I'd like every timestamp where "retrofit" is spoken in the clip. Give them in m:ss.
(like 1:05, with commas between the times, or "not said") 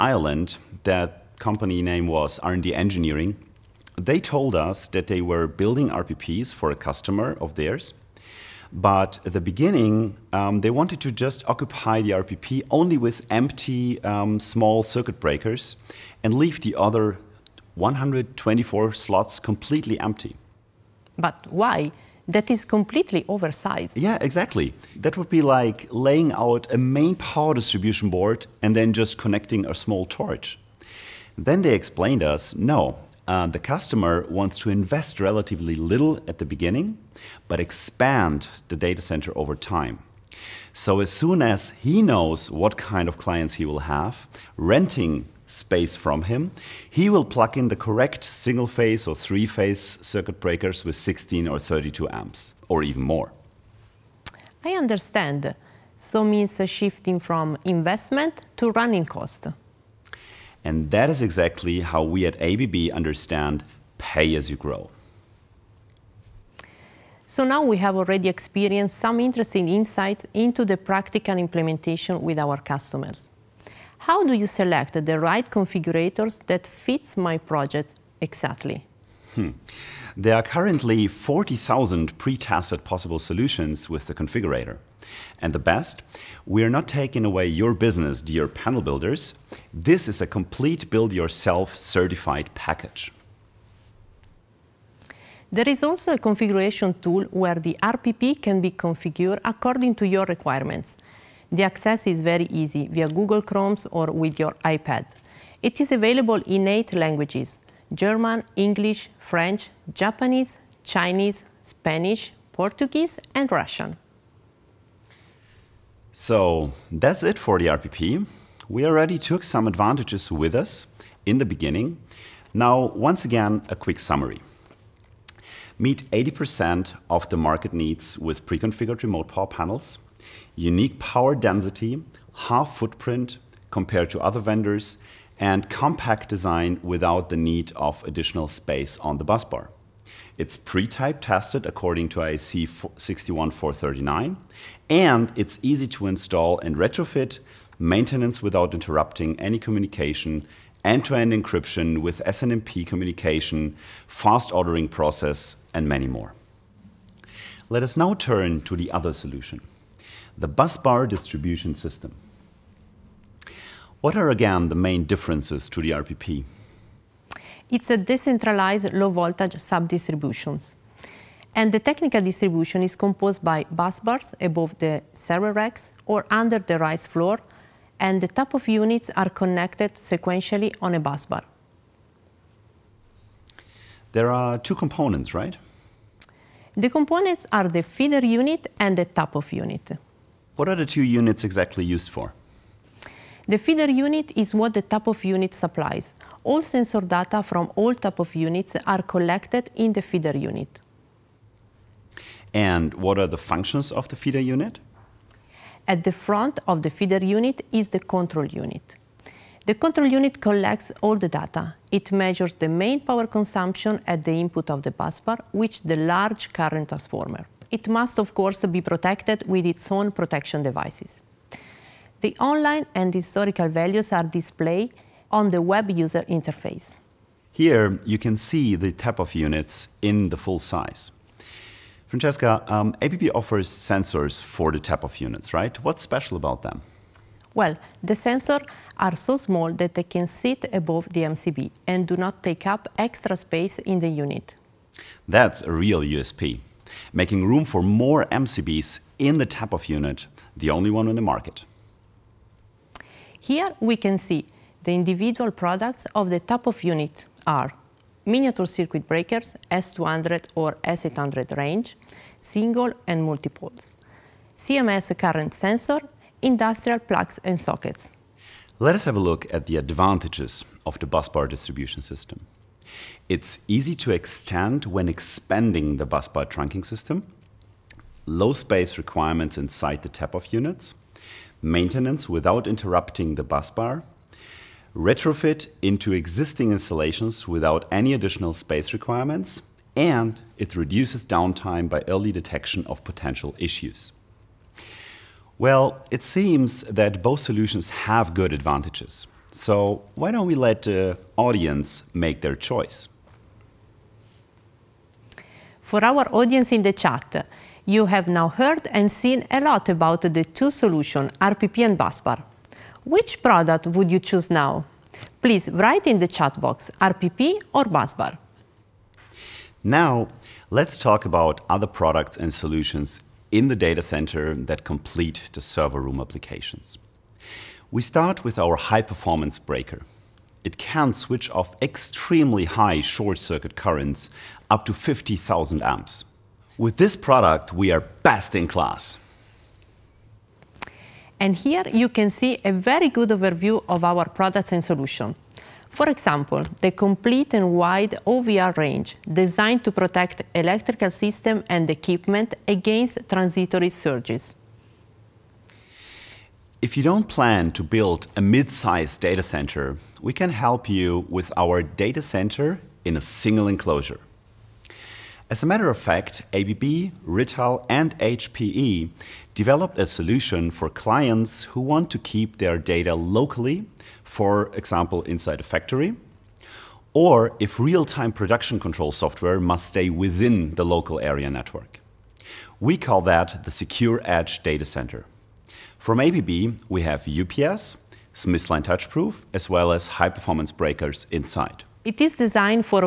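2:26, 4:44.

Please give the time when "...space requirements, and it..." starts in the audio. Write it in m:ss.
4:48.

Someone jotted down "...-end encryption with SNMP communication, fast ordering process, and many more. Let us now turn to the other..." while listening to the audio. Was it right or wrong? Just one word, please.
right.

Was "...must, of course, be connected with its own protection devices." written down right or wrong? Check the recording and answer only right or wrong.
wrong.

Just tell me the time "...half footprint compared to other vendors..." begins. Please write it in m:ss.
2:12.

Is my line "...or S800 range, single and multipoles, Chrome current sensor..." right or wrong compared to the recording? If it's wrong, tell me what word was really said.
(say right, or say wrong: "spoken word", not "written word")
wrong: "CMS", not "Chrome".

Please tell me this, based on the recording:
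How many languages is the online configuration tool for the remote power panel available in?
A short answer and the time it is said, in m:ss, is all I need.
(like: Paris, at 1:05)
8, at 1:46.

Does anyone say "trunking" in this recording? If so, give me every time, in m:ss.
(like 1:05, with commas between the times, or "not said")
4:36.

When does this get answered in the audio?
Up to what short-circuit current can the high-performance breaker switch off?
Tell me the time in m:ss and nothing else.
5:34.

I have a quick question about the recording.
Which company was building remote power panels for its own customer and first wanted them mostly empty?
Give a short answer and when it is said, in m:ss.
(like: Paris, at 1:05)
R&D Engineering, at 0:02.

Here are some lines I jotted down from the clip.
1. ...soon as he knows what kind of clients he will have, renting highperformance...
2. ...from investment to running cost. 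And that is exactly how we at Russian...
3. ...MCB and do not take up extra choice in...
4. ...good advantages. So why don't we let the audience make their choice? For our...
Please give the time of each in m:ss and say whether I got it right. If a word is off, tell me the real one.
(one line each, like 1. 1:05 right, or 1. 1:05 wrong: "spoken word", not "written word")
1. 0:41 wrong: "space", not "highperformance"
2. 0:57 wrong: "ABB", not "Russian"
3. 4:01 wrong: "space", not "choice"
4. 4:58 right.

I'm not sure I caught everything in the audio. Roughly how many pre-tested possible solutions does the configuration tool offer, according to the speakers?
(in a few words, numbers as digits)
40,000.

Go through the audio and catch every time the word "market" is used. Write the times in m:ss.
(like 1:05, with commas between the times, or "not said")
2:07, 4:11.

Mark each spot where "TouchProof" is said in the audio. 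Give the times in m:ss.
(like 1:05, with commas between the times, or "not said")
6:28.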